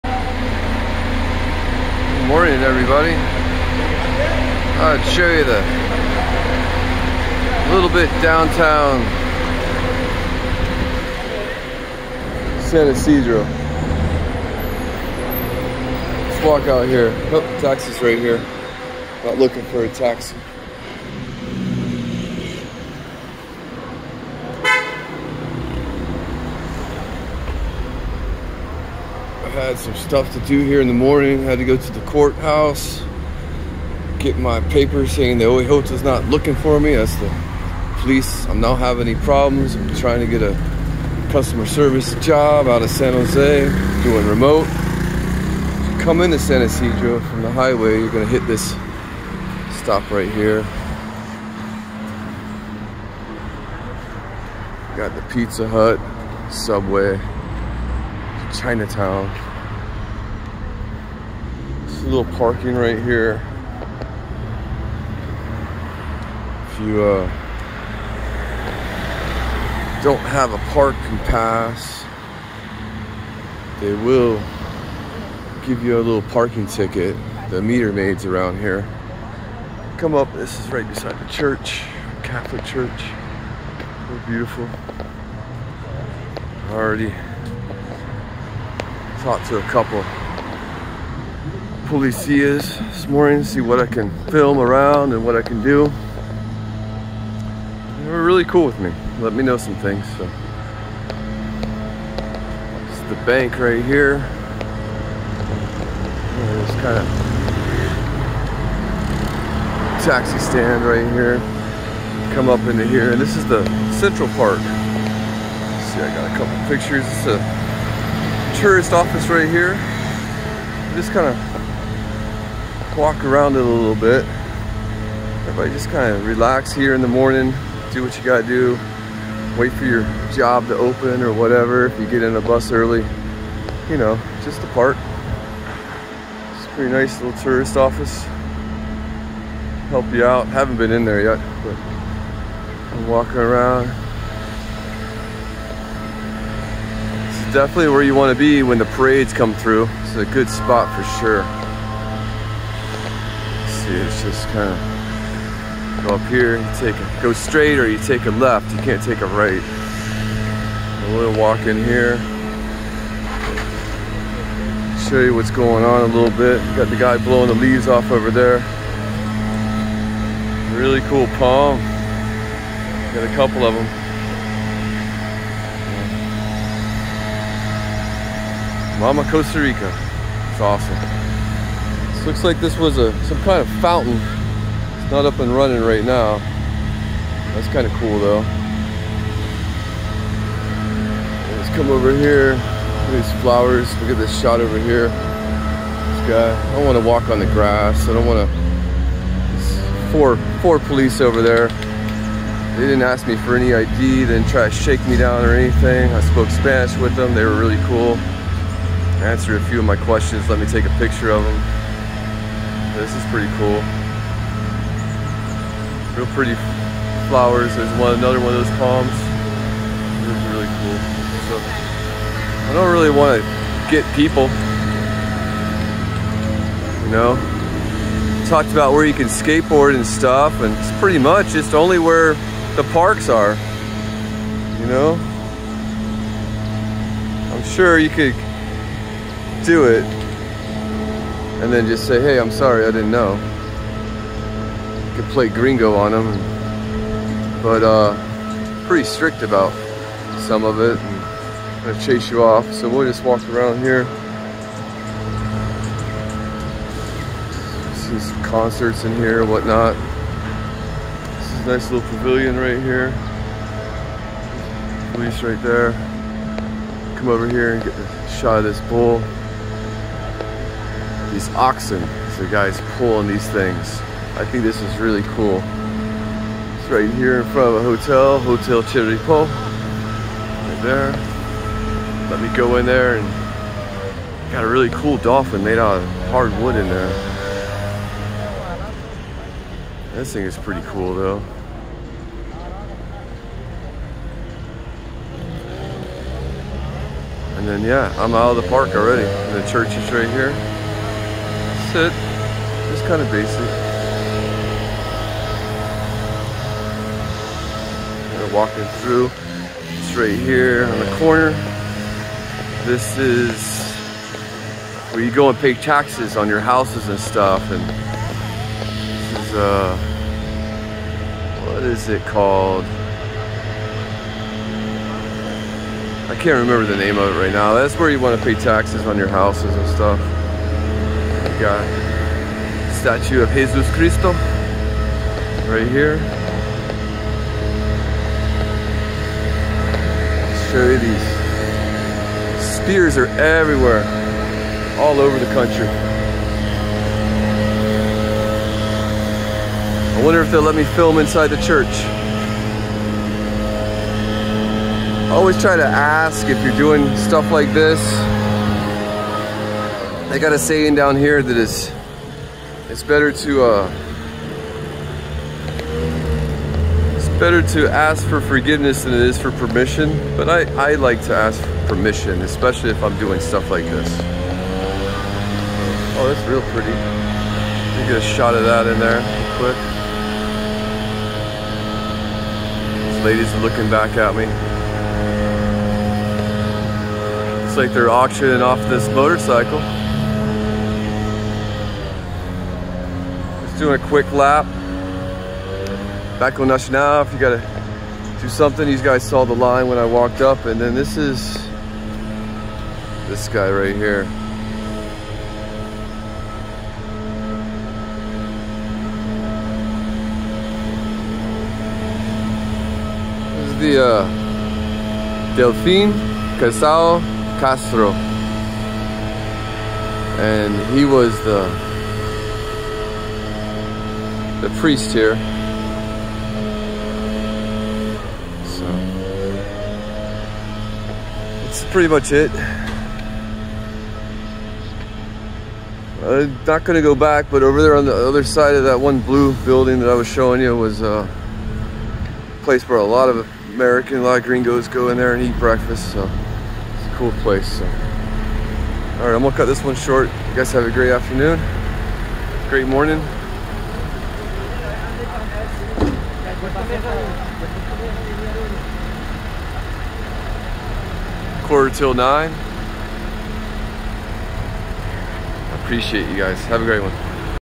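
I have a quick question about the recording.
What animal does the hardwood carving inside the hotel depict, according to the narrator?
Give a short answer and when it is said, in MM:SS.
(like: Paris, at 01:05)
Dolphin, at 04:45.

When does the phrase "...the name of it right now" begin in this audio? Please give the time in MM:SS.
05:26.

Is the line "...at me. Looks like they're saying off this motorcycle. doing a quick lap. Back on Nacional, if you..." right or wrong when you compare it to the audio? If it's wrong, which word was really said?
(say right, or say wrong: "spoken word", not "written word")
wrong: "auctioning", not "saying".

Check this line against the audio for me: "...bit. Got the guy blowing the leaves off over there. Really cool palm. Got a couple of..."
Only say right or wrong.
right.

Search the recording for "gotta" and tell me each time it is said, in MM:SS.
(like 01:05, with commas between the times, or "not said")
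02:08, 06:37.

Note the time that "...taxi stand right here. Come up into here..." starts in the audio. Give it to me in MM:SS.
01:50.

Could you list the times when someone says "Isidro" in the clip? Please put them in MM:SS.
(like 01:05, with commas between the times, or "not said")
00:12, 00:46.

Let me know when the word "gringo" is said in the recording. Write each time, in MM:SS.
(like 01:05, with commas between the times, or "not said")
04:05, 07:24.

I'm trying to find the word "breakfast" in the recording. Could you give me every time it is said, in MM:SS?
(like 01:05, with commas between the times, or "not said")
07:25.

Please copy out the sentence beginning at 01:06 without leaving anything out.
If you uh, don't have a parking pass, they will give you a little parking ticket.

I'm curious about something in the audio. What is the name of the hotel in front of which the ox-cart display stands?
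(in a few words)
Hotel Chirripó.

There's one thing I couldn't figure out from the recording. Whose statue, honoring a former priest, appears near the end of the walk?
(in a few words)
Delfin Quesada Castro.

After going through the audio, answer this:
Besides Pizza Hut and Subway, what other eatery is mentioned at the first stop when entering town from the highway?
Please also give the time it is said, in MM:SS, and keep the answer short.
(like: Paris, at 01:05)
Chinatown, at 00:58.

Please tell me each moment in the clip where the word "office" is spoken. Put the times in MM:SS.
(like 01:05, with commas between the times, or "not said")
01:58, 02:17.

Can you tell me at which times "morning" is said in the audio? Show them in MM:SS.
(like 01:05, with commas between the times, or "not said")
00:02, 00:30, 01:33, 02:07, 07:32.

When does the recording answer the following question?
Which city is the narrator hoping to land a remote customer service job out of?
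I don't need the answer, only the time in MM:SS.
00:42.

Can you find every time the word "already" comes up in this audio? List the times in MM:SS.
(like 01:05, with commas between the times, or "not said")
01:26, 04:58.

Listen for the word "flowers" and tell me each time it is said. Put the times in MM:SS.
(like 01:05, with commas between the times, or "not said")
03:13, 03:37.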